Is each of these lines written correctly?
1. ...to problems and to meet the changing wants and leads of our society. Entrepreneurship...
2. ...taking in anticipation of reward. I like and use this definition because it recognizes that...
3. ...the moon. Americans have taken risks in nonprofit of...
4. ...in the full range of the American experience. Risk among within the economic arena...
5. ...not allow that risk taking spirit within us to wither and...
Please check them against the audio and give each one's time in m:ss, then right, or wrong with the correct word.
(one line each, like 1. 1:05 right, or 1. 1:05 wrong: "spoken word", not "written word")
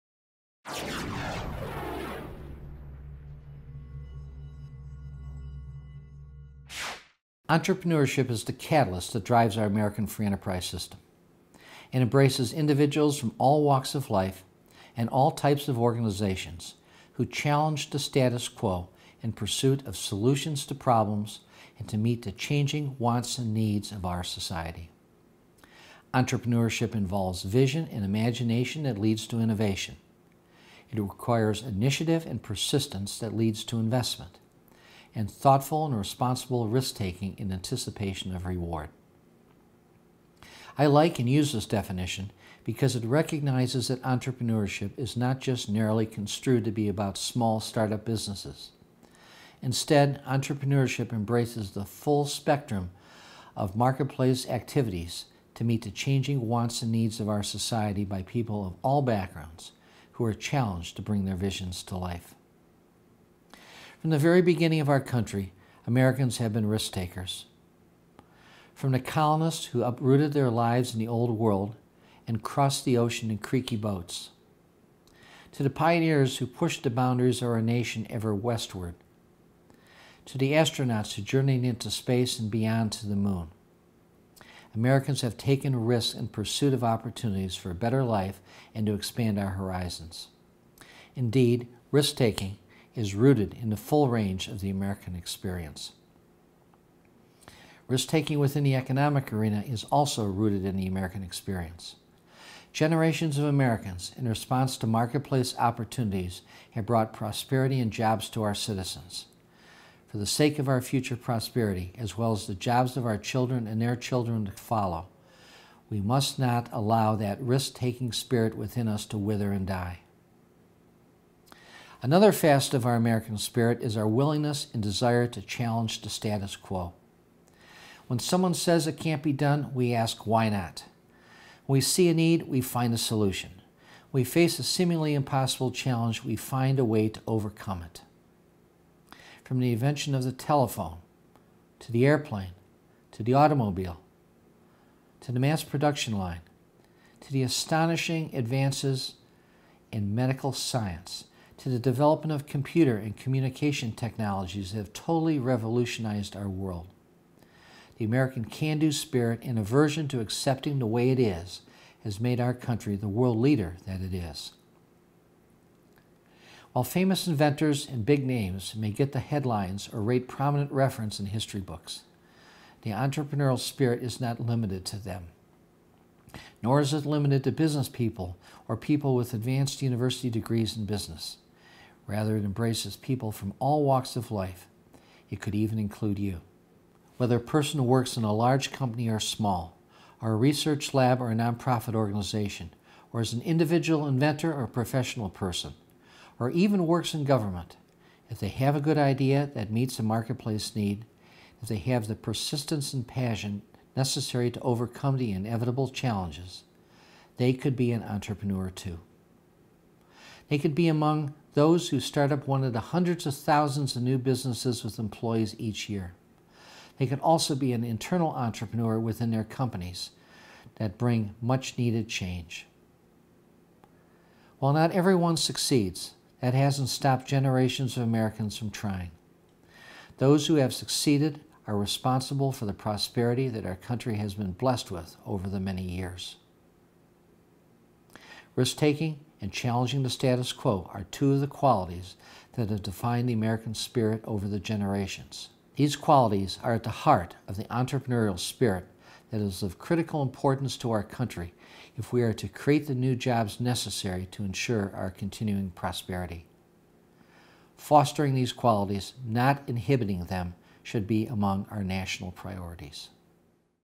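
1. 0:20 wrong: "needs", not "leads"
2. 0:36 right
3. 1:23 wrong: "pursuit", not "nonprofit"
4. 1:33 wrong: "taking", not "among"
5. 1:56 right.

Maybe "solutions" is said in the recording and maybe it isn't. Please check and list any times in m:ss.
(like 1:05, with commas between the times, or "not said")
0:19, 2:12.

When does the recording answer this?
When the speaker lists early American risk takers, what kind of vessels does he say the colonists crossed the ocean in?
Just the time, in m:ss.
1:13.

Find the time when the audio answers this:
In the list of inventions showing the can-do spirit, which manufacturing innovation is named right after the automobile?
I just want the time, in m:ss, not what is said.
2:25.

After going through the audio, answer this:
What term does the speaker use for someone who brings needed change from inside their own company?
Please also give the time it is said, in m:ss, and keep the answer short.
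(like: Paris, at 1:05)
internal entrepreneur, at 3:37.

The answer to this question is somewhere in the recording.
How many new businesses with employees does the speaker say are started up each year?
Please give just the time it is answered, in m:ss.
3:32.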